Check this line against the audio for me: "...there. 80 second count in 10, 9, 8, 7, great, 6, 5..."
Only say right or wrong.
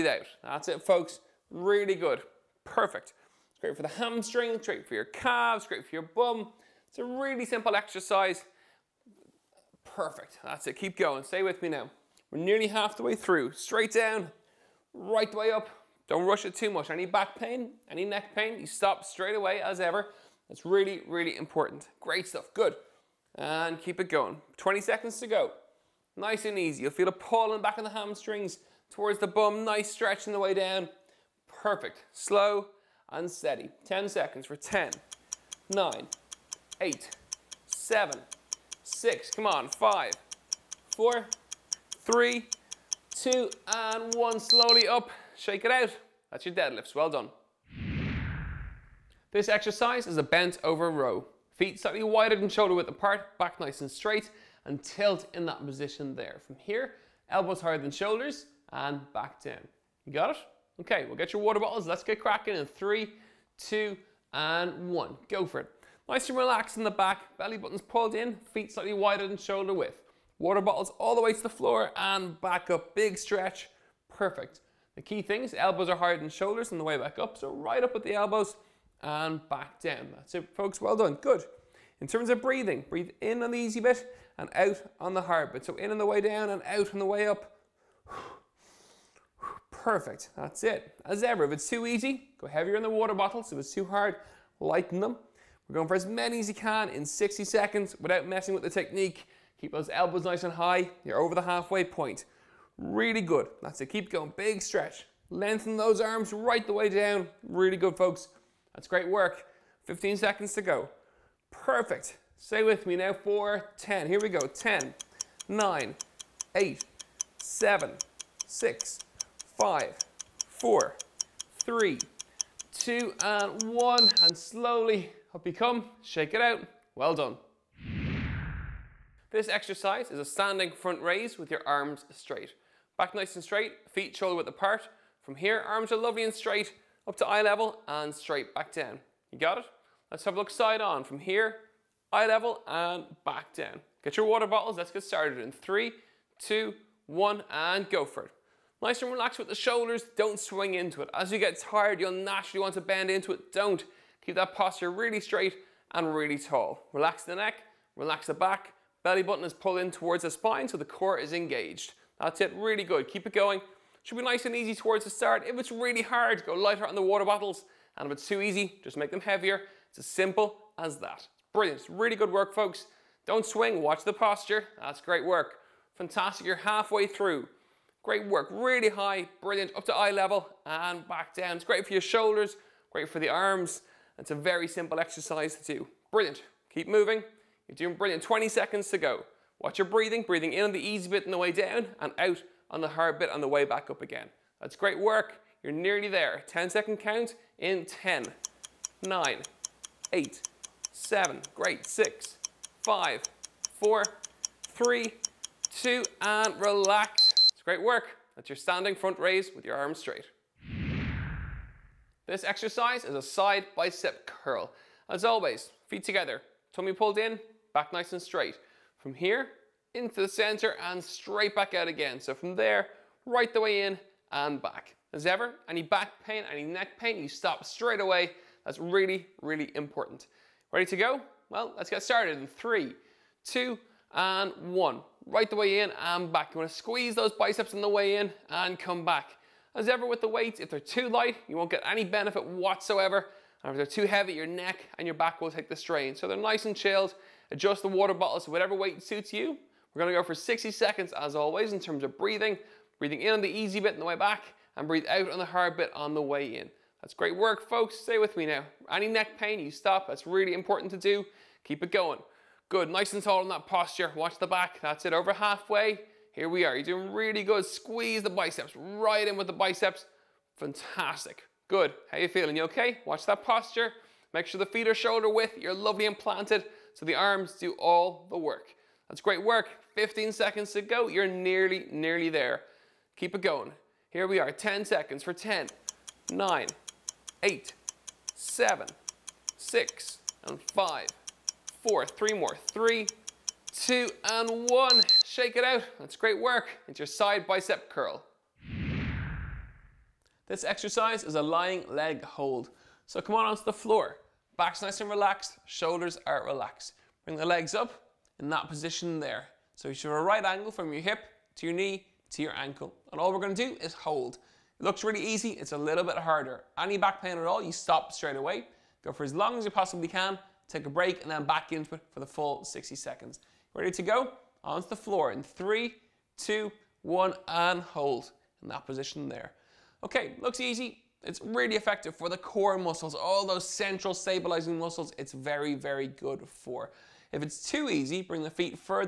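wrong.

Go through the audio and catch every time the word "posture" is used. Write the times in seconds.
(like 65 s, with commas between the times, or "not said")
154 s, 174 s, 263 s, 273 s.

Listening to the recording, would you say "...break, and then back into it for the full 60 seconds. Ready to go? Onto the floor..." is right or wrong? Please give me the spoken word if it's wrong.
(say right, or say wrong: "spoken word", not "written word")
right.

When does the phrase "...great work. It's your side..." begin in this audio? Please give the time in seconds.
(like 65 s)
296 s.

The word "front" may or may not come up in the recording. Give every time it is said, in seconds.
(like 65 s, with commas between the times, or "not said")
130 s, 208 s.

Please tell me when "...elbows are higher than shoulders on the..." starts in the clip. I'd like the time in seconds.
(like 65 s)
75 s.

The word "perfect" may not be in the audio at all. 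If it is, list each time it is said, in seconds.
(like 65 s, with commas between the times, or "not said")
2 s, 9 s, 31 s, 74 s, 89 s, 111 s.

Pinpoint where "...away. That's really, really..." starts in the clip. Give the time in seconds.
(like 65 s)
227 s.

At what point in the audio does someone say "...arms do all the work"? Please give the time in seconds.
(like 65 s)
277 s.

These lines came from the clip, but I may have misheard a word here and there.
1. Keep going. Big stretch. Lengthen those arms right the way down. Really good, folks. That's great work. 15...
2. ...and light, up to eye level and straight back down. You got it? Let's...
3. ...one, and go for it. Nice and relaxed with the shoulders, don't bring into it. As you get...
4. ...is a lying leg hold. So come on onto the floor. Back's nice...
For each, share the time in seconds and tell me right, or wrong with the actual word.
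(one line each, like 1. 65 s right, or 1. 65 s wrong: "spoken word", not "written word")
1. 103 s right
2. 136 s wrong: "straight", not "light"
3. 147 s wrong: "swing", not "bring"
4. 301 s right.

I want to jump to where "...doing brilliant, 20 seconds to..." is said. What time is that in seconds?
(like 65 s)
187 s.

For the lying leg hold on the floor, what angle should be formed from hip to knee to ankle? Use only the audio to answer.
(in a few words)
Right angle.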